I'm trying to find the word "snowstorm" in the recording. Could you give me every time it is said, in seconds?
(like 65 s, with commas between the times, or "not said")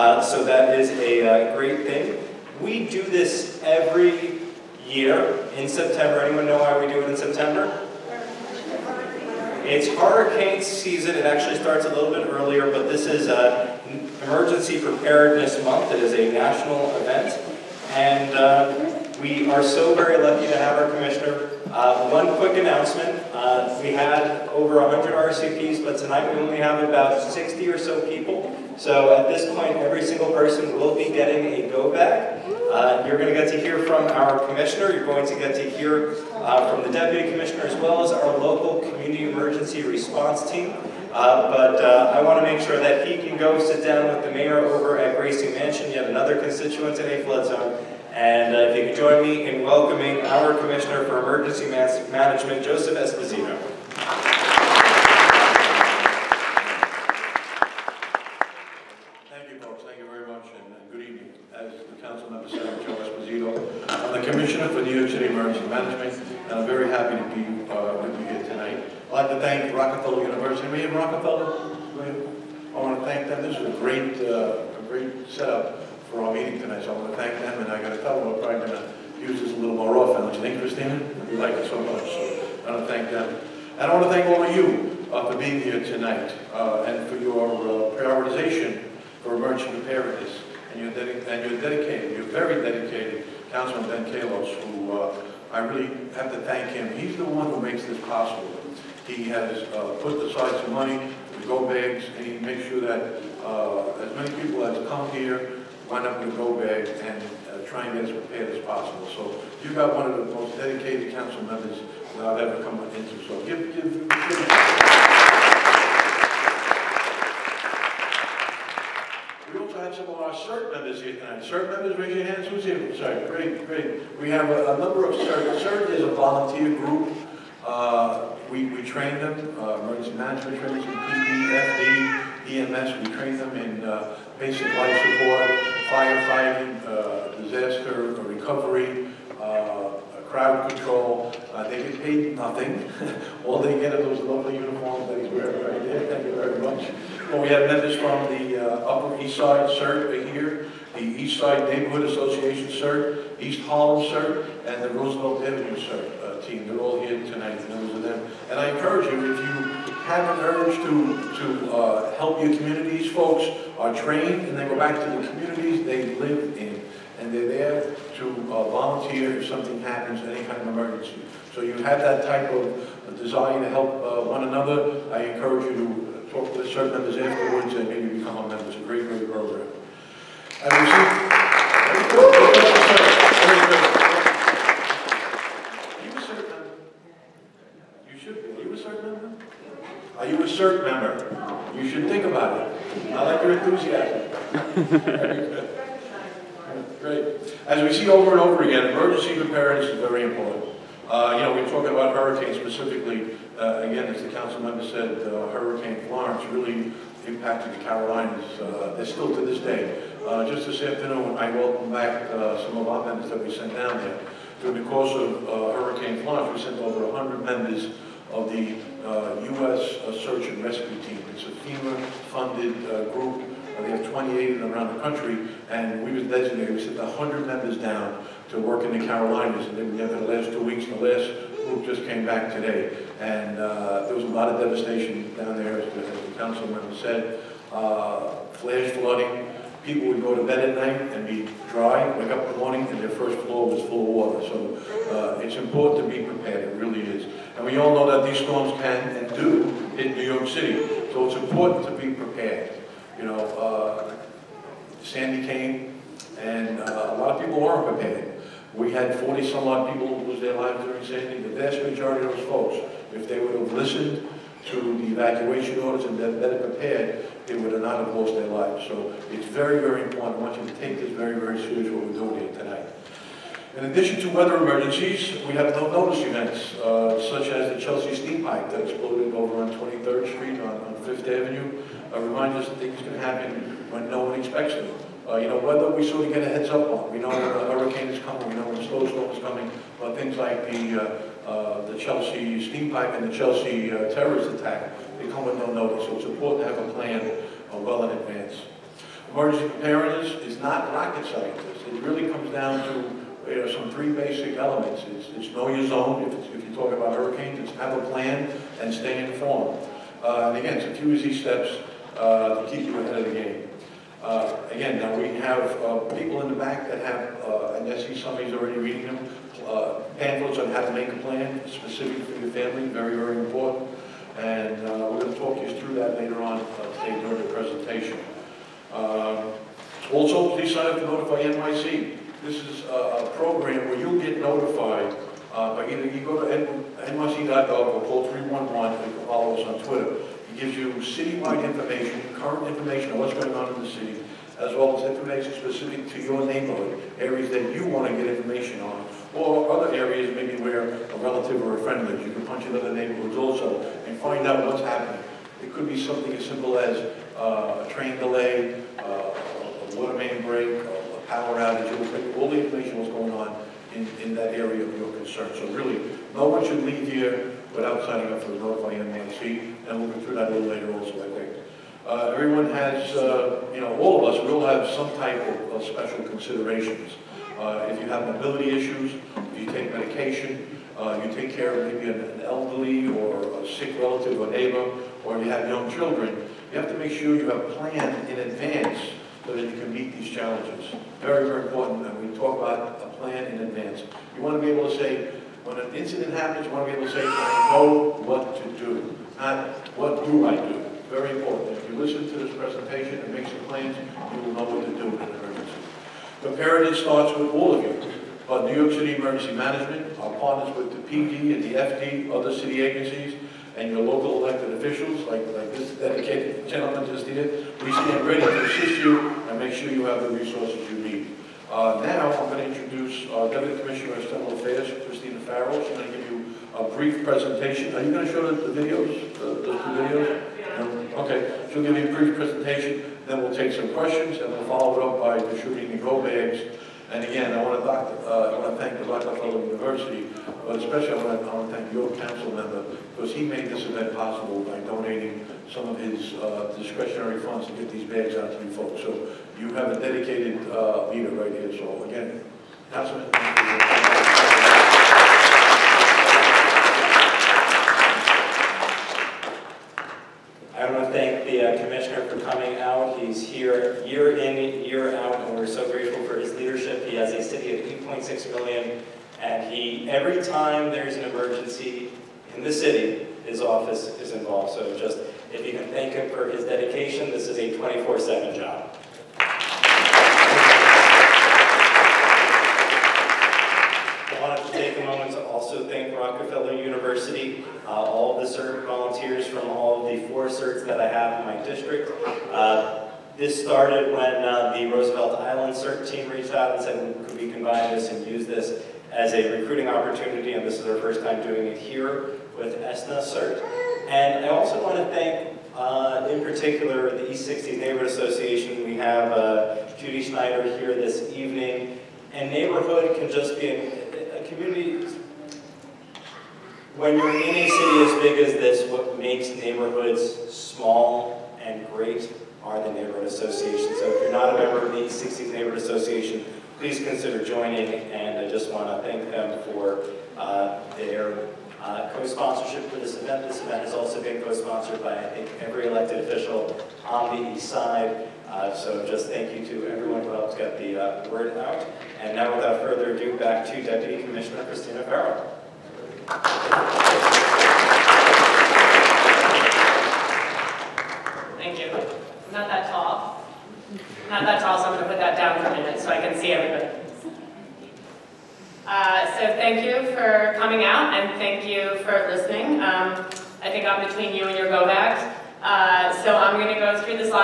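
288 s.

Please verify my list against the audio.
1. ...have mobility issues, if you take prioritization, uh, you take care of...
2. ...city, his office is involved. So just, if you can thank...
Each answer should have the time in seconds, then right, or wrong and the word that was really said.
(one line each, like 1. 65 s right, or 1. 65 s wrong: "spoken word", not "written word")
1. 378 s wrong: "medication", not "prioritization"
2. 472 s right.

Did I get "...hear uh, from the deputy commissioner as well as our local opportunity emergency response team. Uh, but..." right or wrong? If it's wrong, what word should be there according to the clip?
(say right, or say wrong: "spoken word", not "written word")
wrong: "community", not "opportunity".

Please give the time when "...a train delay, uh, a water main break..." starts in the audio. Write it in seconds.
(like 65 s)
357 s.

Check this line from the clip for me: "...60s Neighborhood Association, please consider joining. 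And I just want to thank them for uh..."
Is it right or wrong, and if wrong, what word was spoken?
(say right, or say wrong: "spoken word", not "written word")
right.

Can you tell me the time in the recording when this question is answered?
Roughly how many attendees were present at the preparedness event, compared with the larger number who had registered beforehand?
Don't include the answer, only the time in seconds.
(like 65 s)
26 s.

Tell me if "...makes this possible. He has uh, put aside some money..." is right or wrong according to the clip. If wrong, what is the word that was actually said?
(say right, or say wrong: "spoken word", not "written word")
right.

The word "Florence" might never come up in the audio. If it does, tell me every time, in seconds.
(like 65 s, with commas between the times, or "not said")
206 s, 216 s.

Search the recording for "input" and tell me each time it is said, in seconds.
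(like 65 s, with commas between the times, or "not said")
not said.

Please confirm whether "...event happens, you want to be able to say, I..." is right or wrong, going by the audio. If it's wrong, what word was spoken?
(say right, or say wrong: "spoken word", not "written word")
wrong: "incident", not "event".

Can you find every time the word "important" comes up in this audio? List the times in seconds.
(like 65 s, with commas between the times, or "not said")
200 s, 245 s, 251 s, 270 s, 296 s, 323 s, 391 s, 401 s.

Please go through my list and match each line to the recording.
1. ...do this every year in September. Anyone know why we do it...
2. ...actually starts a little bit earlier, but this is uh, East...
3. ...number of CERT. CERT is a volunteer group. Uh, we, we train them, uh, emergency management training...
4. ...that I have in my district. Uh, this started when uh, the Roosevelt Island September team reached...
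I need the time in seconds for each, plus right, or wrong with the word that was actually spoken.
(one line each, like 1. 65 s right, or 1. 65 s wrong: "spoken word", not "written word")
1. 2 s right
2. 11 s wrong: "Emergency", not "East"
3. 124 s right
4. 490 s wrong: "CERT", not "September".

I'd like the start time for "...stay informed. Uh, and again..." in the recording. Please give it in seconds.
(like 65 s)
308 s.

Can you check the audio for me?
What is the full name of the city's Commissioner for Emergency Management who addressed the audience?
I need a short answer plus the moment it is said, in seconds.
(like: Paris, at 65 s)
Joseph Esposito, at 52 s.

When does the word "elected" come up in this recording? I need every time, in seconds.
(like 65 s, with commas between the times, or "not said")
414 s, 535 s.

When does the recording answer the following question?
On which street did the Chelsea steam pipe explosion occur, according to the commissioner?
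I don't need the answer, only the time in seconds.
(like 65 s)
279 s.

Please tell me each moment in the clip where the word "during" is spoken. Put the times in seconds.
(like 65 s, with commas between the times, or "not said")
214 s, 260 s, 327 s.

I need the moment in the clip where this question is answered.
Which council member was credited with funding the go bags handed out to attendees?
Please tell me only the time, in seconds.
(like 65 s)
93 s.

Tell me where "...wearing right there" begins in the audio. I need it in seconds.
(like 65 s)
145 s.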